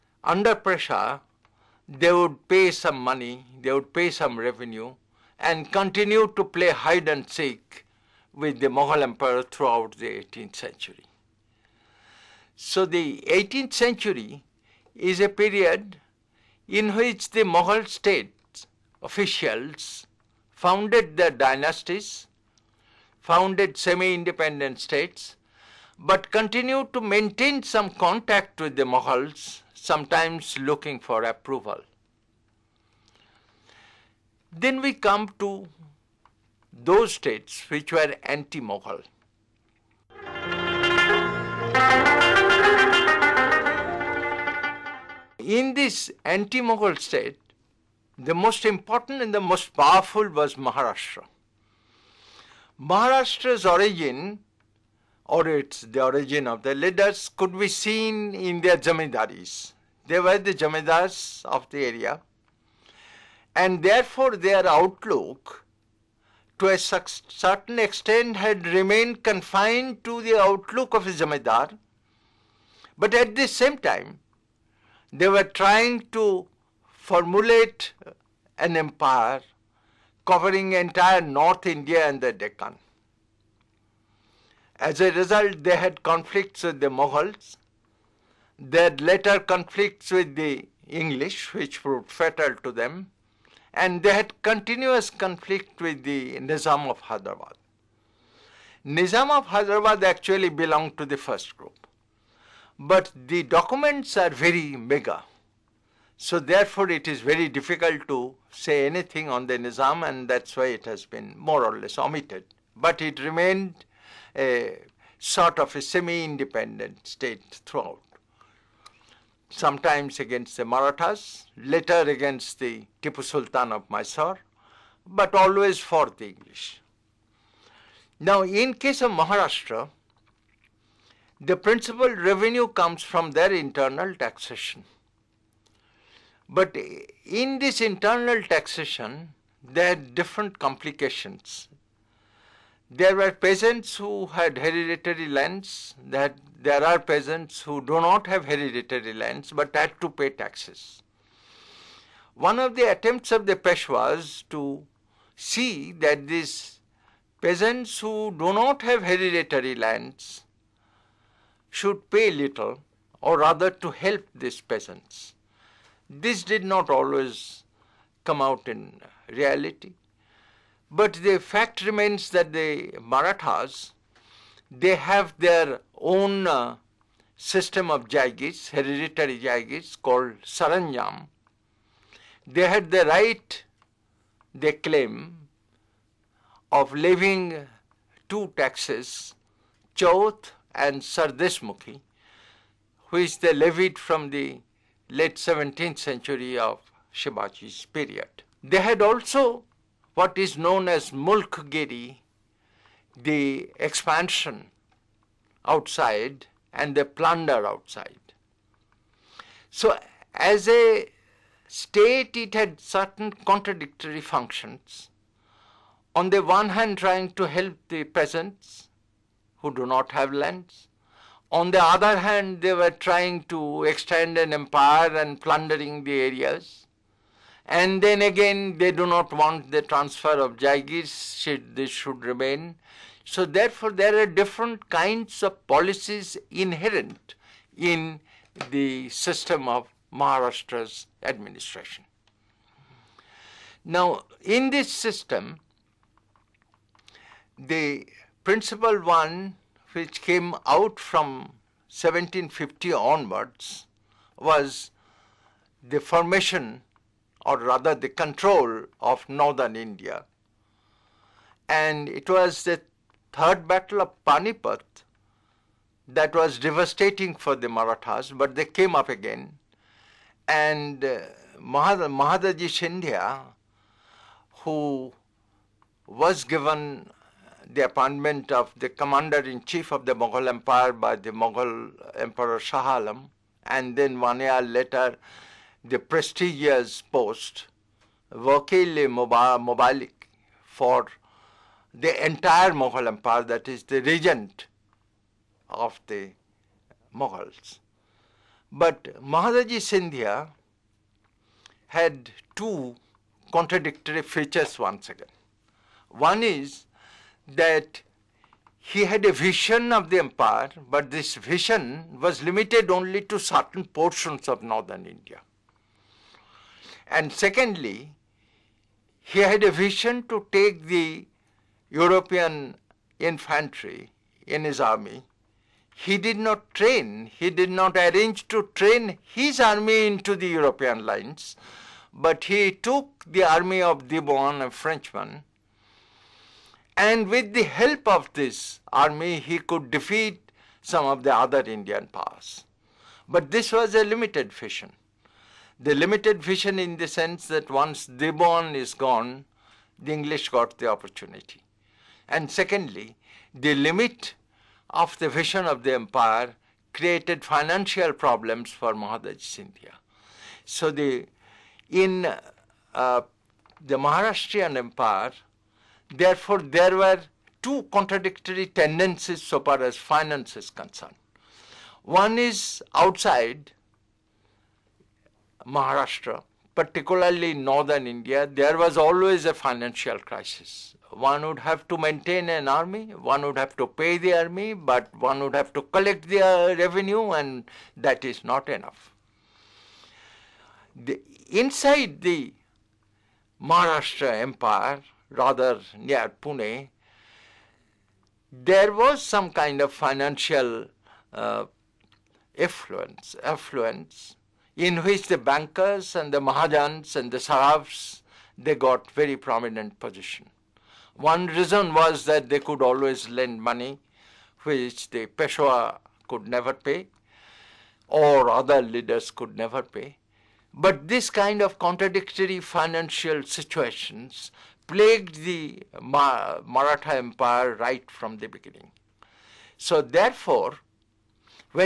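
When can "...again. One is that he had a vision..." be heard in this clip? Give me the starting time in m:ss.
5:05.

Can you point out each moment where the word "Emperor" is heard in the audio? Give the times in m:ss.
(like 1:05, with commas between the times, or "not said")
4:42.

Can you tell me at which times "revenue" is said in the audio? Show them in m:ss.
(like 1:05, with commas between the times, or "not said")
0:04, 2:12, 6:26.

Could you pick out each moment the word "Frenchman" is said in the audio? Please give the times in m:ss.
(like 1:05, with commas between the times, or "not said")
5:34.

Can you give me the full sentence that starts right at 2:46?
This did not always come out in reality.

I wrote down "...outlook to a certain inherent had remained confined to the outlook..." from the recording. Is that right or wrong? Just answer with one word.
wrong.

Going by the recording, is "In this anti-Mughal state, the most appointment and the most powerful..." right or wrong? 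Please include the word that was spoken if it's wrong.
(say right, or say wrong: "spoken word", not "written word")
wrong: "important", not "appointment".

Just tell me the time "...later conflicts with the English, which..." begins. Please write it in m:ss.
1:29.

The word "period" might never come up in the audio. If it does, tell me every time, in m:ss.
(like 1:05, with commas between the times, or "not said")
0:15, 3:17.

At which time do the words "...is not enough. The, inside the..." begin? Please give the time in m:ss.
6:28.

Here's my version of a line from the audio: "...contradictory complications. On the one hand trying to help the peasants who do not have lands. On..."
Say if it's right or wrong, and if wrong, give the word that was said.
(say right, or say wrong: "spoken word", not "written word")
wrong: "functions", not "complications".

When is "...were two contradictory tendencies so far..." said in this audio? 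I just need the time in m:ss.
6:06.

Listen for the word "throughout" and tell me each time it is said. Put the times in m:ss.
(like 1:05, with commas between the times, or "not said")
0:09, 1:57.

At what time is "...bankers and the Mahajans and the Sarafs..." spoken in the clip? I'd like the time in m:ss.
6:45.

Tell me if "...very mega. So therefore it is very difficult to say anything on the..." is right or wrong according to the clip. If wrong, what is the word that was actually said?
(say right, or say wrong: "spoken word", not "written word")
right.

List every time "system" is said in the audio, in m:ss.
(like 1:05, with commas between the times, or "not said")
2:57, 3:59, 4:04.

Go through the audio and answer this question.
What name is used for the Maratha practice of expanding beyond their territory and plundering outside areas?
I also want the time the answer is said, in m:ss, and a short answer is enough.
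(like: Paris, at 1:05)
Mulkgiri, at 3:21.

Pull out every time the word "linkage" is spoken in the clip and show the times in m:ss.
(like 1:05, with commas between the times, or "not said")
not said.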